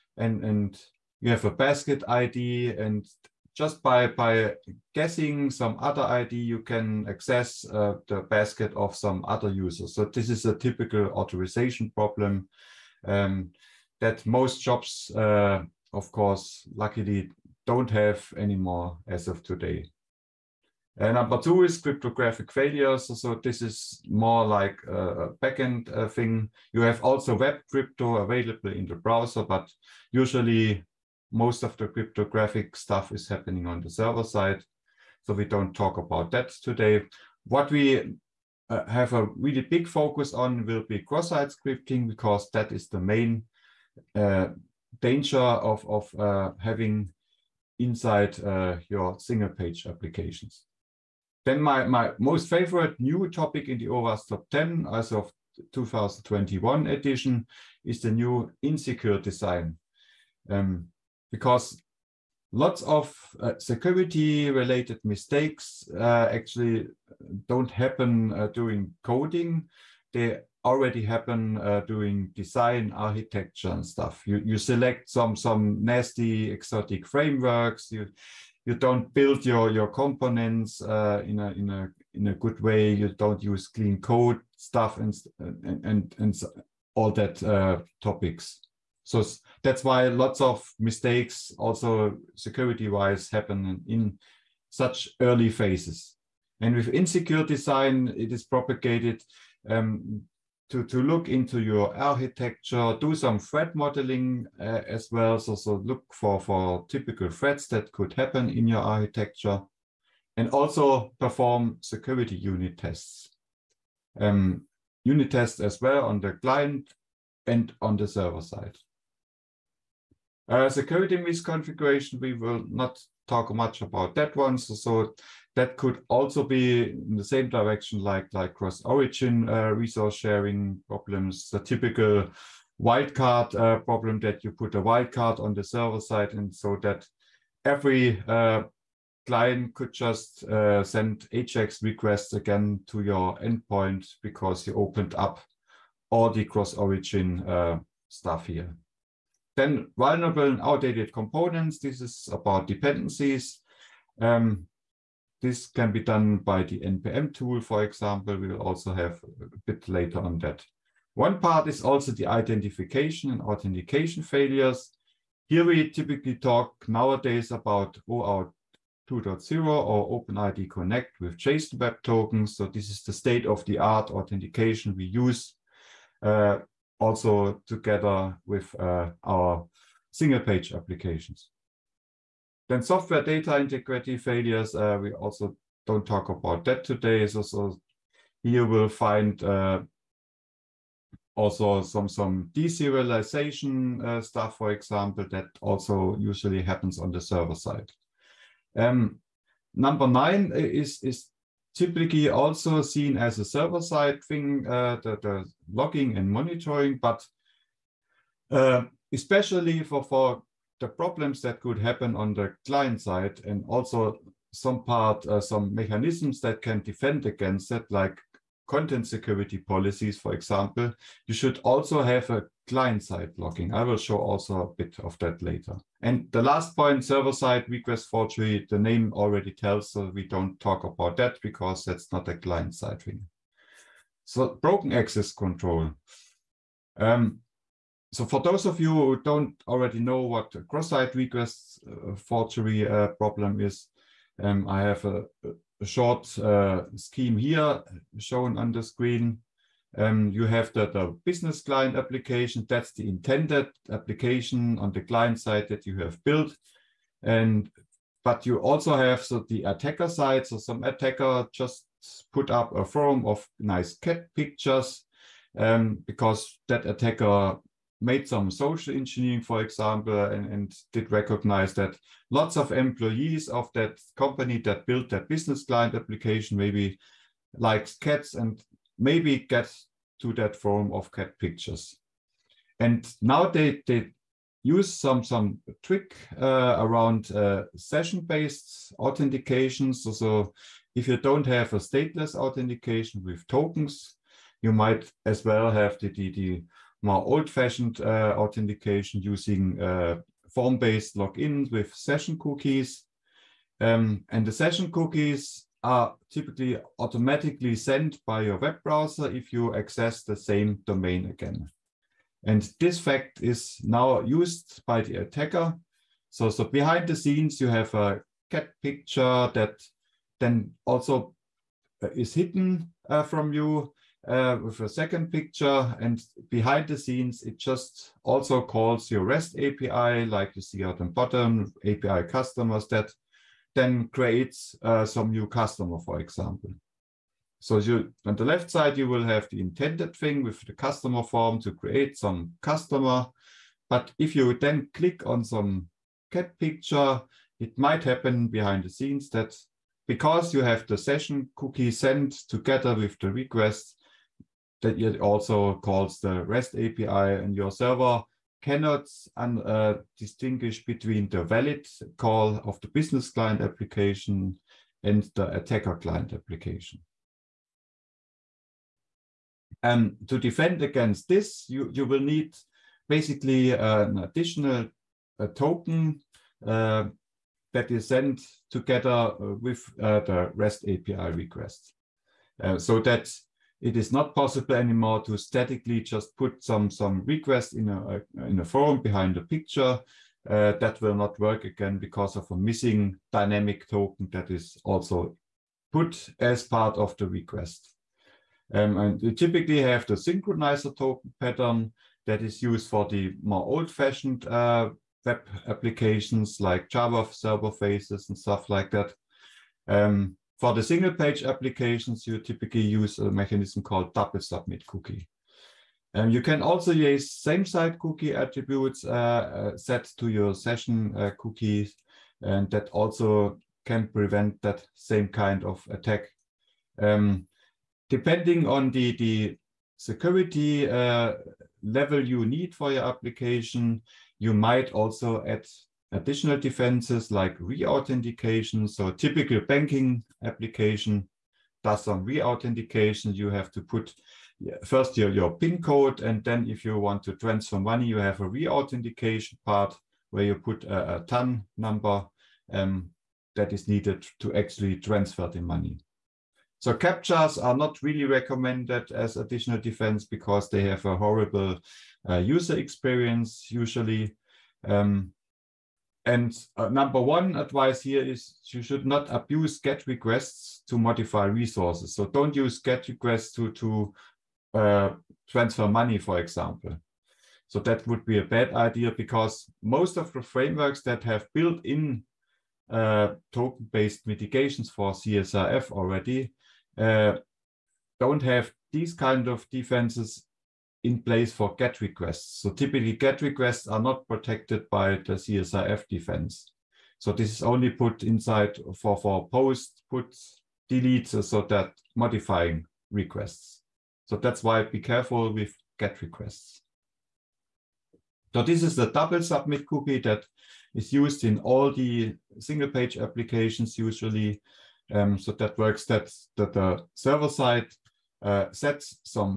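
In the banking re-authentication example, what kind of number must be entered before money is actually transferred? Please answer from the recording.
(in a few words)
TAN number.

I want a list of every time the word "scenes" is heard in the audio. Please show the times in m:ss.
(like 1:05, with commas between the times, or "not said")
5:17, 5:26, 5:48.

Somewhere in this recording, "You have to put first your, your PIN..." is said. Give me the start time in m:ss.
7:23.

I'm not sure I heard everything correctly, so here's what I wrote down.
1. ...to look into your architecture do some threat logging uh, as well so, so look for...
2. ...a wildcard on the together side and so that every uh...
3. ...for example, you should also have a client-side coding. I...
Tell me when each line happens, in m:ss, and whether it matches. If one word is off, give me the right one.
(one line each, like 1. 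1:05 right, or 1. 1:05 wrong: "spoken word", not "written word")
1. 1:40 wrong: "modeling", not "logging"
2. 2:14 wrong: "server", not "together"
3. 3:40 wrong: "blocking", not "coding".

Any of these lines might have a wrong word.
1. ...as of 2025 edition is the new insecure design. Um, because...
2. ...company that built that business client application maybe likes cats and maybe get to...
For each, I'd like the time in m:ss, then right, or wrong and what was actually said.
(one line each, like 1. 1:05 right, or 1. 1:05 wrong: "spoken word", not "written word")
1. 0:54 wrong: "2021", not "2025"
2. 4:34 right.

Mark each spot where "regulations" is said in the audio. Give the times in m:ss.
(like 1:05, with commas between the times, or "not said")
not said.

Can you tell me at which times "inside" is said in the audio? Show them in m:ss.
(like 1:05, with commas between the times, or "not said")
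0:47, 8:18.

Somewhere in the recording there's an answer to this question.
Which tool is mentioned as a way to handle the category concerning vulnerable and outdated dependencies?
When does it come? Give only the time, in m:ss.
2:36.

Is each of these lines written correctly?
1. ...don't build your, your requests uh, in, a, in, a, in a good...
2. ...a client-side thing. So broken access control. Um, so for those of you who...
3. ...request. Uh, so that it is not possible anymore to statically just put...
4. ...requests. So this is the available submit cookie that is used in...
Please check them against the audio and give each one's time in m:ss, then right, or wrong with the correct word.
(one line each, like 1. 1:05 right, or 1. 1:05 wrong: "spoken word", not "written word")
1. 1:18 wrong: "components", not "requests"
2. 3:52 right
3. 6:21 right
4. 8:26 wrong: "double", not "available".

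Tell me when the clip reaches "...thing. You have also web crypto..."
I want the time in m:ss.
0:26.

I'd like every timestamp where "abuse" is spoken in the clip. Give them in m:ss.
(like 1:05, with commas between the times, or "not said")
7:49.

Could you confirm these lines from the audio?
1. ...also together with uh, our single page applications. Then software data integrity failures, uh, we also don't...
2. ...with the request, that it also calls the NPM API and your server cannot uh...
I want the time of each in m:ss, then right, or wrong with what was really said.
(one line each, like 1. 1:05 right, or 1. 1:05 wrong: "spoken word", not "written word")
1. 2:57 right
2. 5:52 wrong: "REST", not "NPM".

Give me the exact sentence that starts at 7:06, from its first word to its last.
Um, depending on the, the security uh, level you need for your application, you might also add additional defenses like re-authentication.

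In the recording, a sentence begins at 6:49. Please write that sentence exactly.
Um, for the single page applications, you typically use a mechanism called double submit cookie.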